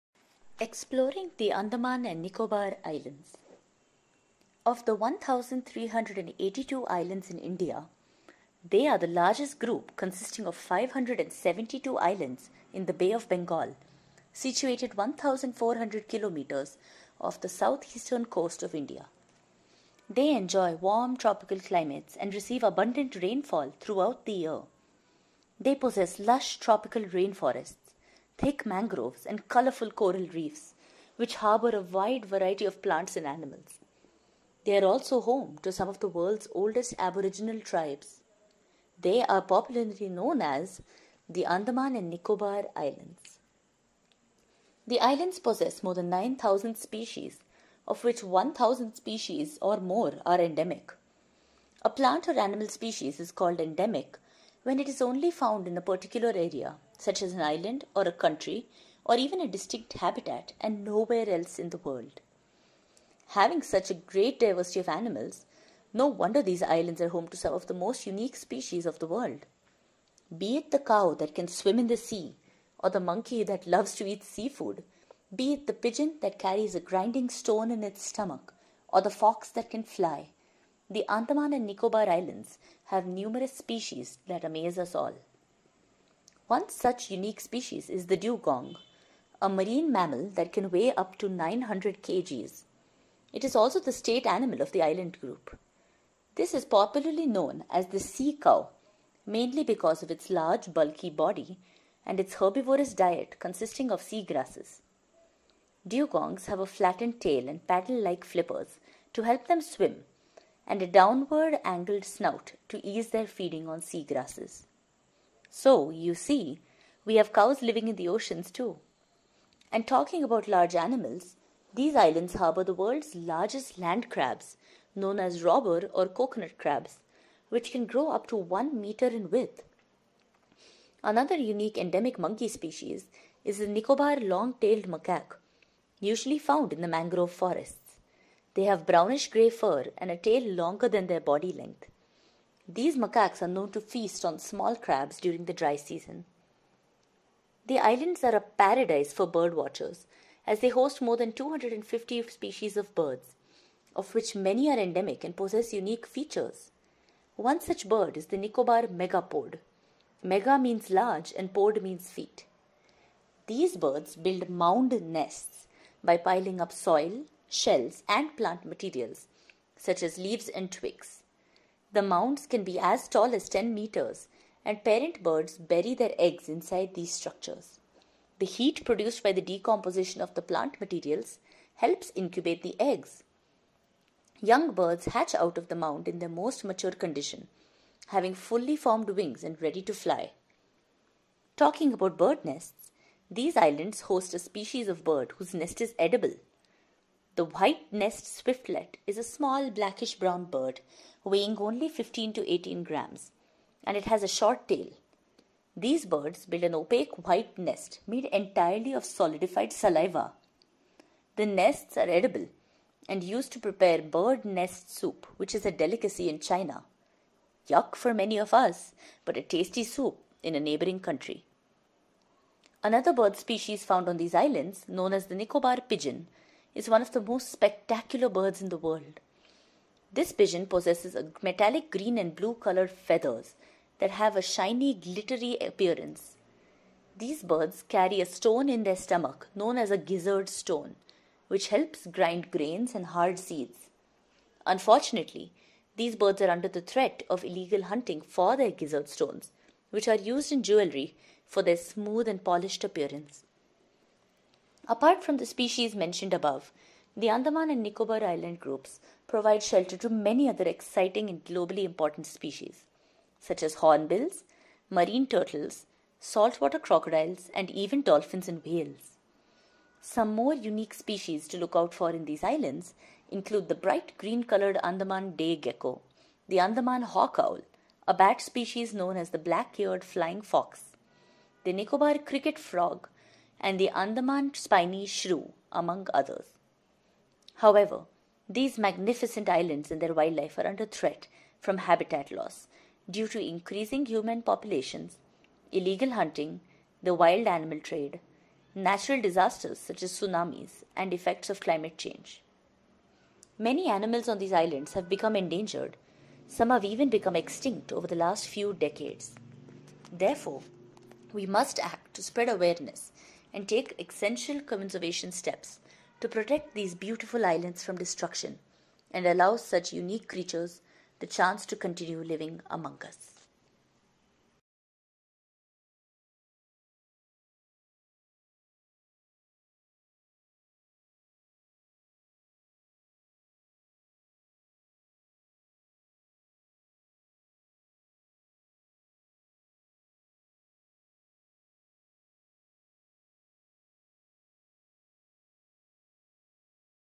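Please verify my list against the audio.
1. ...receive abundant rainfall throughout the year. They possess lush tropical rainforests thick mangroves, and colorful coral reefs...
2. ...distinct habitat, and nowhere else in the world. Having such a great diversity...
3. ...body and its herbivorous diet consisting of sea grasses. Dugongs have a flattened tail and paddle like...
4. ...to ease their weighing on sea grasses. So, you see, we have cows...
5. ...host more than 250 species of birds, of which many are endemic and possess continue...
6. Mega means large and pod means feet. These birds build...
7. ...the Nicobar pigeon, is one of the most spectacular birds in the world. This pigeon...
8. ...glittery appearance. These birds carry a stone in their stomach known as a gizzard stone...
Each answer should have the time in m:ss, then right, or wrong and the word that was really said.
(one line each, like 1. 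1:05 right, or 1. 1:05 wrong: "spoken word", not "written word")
1. 0:22 right
2. 0:59 right
3. 1:41 right
4. 1:52 wrong: "feeding", not "weighing"
5. 2:30 wrong: "unique", not "continue"
6. 2:40 right
7. 3:45 right
8. 3:54 right.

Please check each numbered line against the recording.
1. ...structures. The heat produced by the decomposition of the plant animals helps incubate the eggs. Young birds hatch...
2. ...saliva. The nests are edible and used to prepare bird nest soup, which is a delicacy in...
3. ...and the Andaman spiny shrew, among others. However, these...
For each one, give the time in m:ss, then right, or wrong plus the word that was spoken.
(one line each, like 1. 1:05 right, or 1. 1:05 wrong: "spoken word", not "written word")
1. 2:57 wrong: "materials", not "animals"
2. 3:29 right
3. 4:43 right.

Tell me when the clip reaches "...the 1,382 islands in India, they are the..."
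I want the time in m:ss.
0:04.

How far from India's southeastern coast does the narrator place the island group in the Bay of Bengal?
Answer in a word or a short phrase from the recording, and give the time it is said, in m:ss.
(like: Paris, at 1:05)
1,400 kilometers, at 0:14.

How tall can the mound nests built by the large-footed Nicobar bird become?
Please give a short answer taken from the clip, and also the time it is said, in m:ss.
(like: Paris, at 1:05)
10 meters, at 2:53.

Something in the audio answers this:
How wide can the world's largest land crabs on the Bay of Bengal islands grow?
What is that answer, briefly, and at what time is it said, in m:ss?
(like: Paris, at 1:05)
1 meter, at 2:08.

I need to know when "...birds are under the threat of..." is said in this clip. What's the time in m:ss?
4:06.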